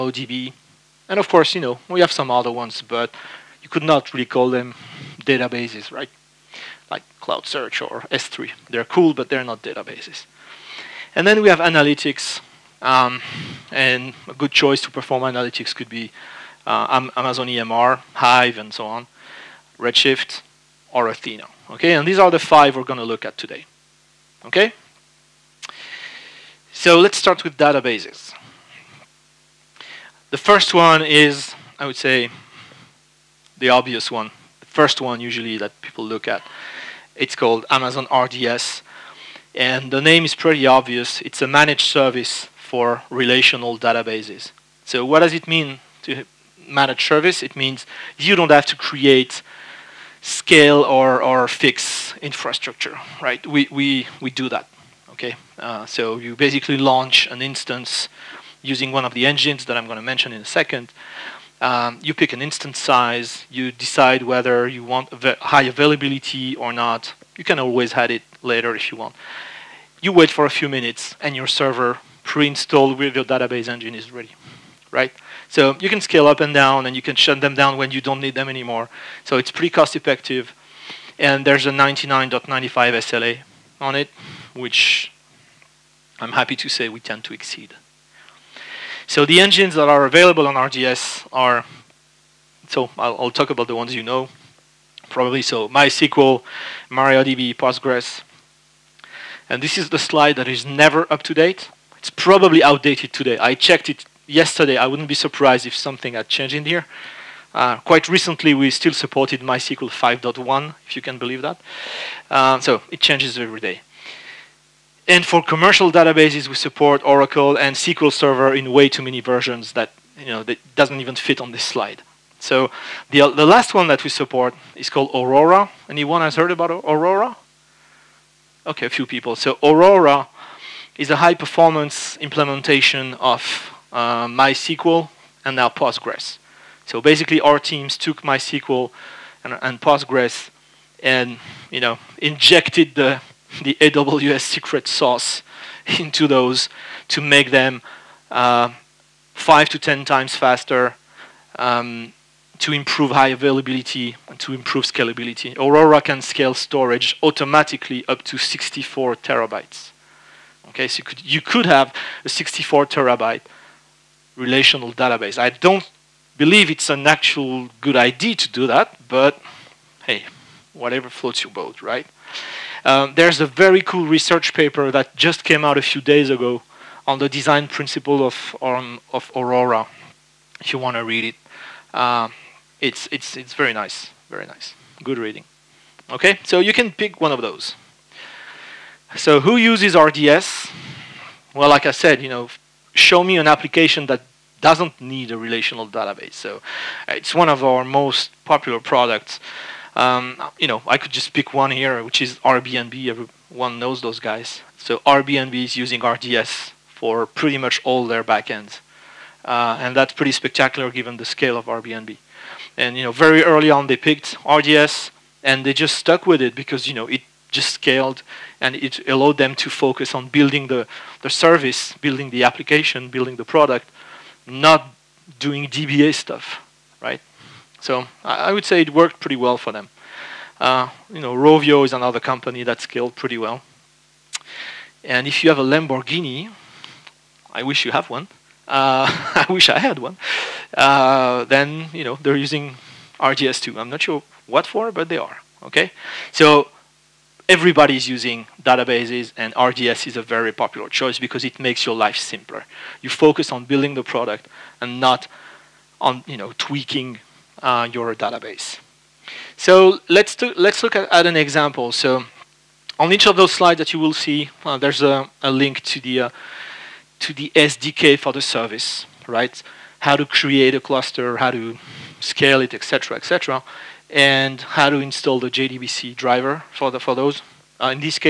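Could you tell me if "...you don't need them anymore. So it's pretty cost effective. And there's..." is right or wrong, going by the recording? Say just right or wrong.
right.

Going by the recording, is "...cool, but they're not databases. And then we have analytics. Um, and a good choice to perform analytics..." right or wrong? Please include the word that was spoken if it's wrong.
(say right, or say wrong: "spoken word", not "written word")
right.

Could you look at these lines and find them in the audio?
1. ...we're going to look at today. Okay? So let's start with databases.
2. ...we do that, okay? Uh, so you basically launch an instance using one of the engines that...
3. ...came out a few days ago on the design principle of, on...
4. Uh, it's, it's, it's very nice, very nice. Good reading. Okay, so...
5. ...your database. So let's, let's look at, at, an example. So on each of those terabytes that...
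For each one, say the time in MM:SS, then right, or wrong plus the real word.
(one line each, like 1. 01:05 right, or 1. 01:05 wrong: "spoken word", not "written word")
1. 00:22 right
2. 00:54 right
3. 02:55 right
4. 03:01 right
5. 04:17 wrong: "slides", not "terabytes".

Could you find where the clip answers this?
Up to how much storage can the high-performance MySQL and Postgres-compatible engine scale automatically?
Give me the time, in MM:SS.
02:38.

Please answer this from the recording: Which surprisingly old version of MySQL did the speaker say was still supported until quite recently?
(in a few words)
MySQL 5.1.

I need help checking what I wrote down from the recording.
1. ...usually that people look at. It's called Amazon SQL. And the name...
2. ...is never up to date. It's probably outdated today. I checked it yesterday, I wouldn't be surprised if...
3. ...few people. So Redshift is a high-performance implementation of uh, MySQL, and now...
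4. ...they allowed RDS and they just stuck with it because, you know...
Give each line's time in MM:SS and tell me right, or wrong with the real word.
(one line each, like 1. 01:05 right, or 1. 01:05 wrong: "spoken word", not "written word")
1. 00:35 wrong: "RDS", not "SQL"
2. 01:40 right
3. 02:08 wrong: "Aurora", not "Redshift"
4. 03:33 wrong: "picked", not "allowed".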